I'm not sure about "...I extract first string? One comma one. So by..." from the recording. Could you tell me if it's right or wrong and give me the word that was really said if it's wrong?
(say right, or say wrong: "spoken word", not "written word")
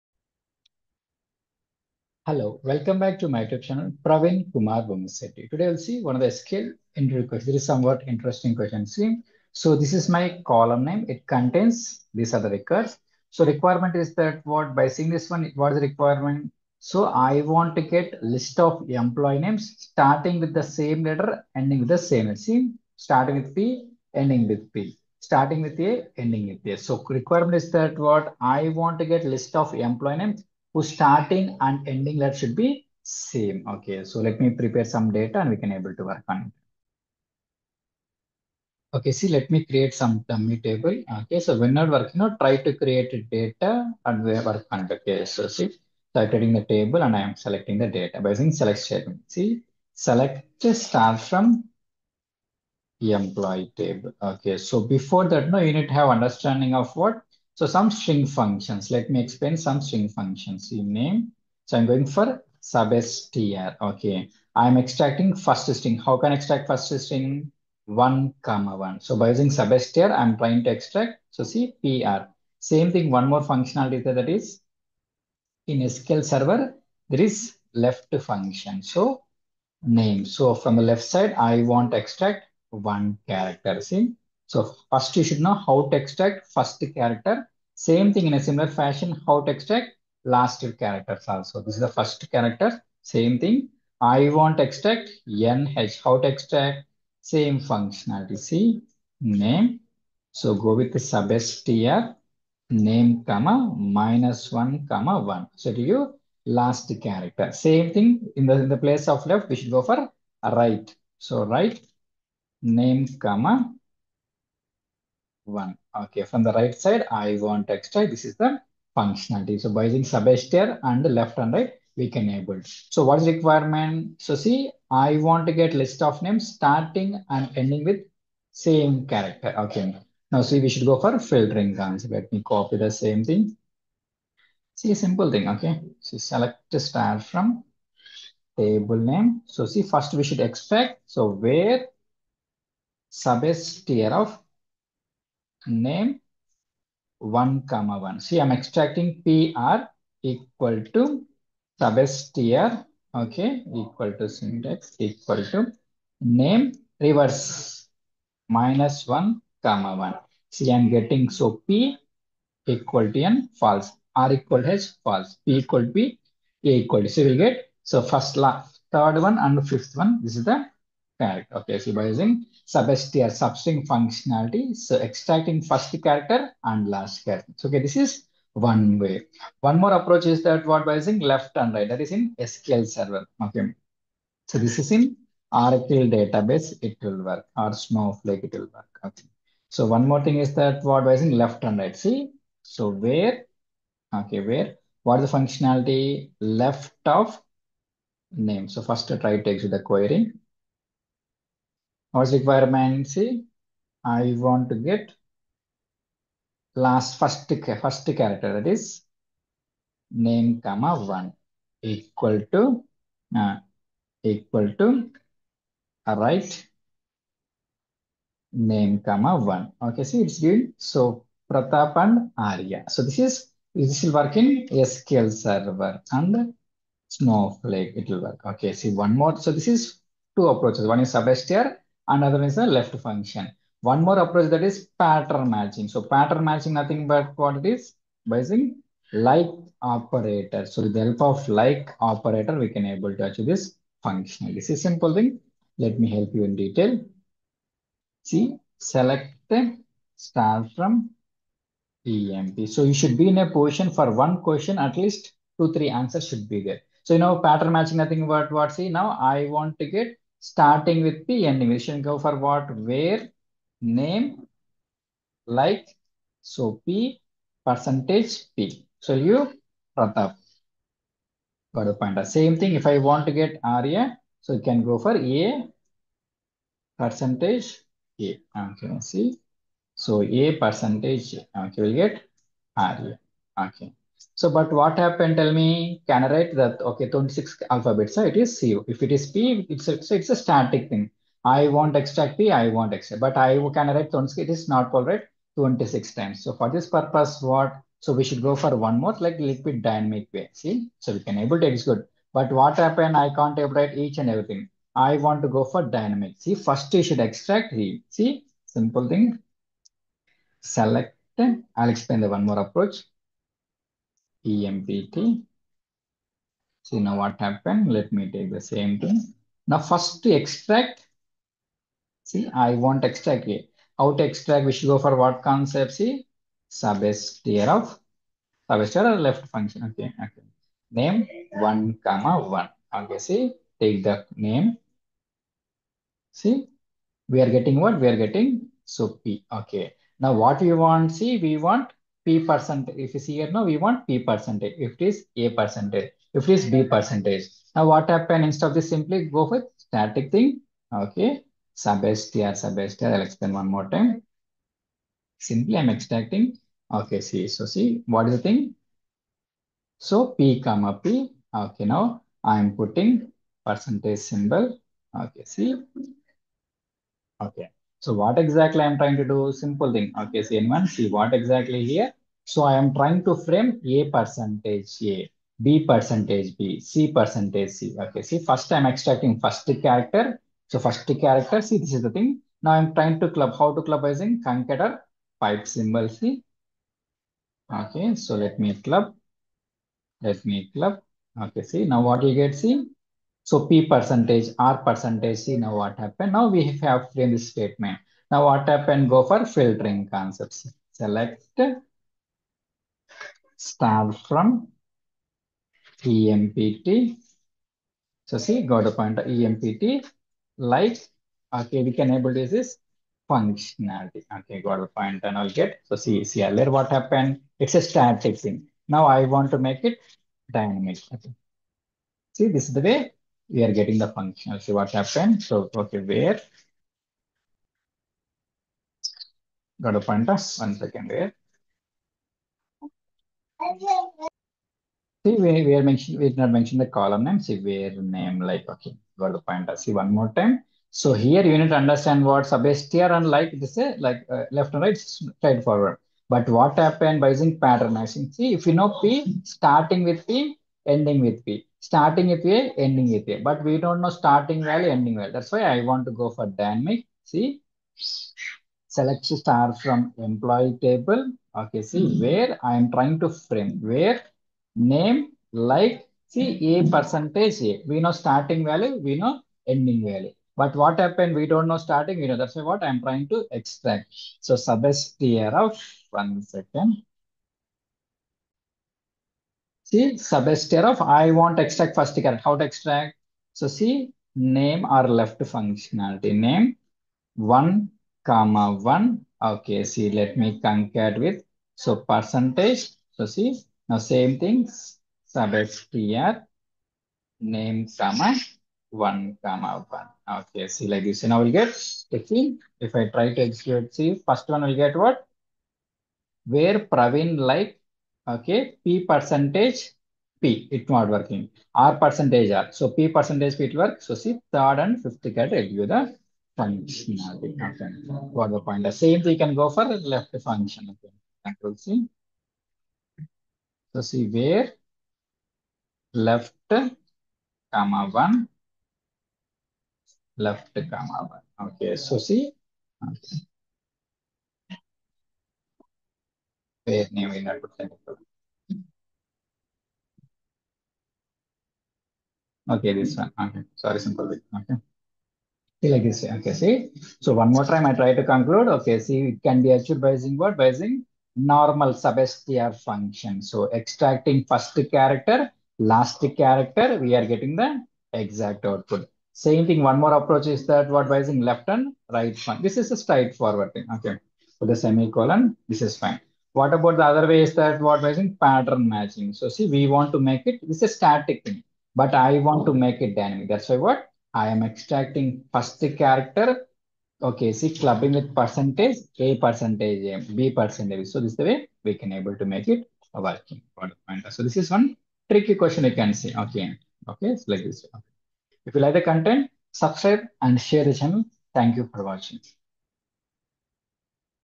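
right.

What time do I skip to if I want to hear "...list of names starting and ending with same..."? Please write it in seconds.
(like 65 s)
125 s.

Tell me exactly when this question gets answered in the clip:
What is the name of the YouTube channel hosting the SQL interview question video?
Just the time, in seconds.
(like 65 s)
4 s.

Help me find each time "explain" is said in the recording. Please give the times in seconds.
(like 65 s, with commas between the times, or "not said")
59 s, 311 s, 353 s.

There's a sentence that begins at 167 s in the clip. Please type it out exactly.
So we'll get, so first, last, third one and fifth one, this is the Correct.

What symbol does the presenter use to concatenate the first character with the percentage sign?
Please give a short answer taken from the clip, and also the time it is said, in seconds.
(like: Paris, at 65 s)
pipe symbol, at 385 s.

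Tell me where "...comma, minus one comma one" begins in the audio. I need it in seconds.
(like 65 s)
103 s.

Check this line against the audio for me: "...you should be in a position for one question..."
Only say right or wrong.
right.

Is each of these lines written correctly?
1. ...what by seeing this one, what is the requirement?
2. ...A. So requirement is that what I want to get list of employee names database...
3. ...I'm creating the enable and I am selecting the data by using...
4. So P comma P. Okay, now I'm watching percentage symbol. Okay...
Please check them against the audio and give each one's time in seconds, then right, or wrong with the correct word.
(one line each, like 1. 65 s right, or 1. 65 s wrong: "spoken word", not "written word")
1. 14 s right
2. 26 s wrong: "whose", not "database"
3. 46 s wrong: "table", not "enable"
4. 359 s wrong: "putting", not "watching".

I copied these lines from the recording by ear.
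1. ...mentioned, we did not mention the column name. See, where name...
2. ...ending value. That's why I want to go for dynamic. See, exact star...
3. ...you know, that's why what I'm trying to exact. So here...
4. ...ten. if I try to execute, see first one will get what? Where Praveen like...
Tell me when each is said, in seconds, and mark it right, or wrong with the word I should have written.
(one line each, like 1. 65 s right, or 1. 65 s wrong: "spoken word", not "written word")
1. 435 s right
2. 454 s wrong: "select", not "exact"
3. 472 s wrong: "extract", not "exact"
4. 502 s wrong: "fifteen", not "ten".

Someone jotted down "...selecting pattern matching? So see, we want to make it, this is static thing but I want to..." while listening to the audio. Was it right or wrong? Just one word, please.
wrong.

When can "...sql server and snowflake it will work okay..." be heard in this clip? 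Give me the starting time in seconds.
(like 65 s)
224 s.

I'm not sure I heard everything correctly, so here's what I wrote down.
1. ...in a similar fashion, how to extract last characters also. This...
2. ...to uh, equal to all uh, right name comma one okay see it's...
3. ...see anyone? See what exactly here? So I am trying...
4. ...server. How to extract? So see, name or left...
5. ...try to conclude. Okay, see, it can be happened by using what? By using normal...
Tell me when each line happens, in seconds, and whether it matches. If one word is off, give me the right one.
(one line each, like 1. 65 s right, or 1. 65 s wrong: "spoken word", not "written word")
1. 88 s right
2. 212 s right
3. 370 s right
4. 482 s wrong: "character", not "server"
5. 547 s wrong: "achieved", not "happened".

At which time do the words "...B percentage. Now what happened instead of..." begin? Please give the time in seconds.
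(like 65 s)
346 s.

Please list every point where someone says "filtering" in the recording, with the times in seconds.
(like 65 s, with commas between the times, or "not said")
131 s, 399 s.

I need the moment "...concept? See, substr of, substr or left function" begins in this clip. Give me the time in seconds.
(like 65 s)
325 s.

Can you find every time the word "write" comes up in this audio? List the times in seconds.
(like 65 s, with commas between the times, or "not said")
286 s, 293 s.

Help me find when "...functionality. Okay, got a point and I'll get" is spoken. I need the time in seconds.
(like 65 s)
413 s.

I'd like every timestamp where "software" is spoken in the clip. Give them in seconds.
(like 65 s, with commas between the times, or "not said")
not said.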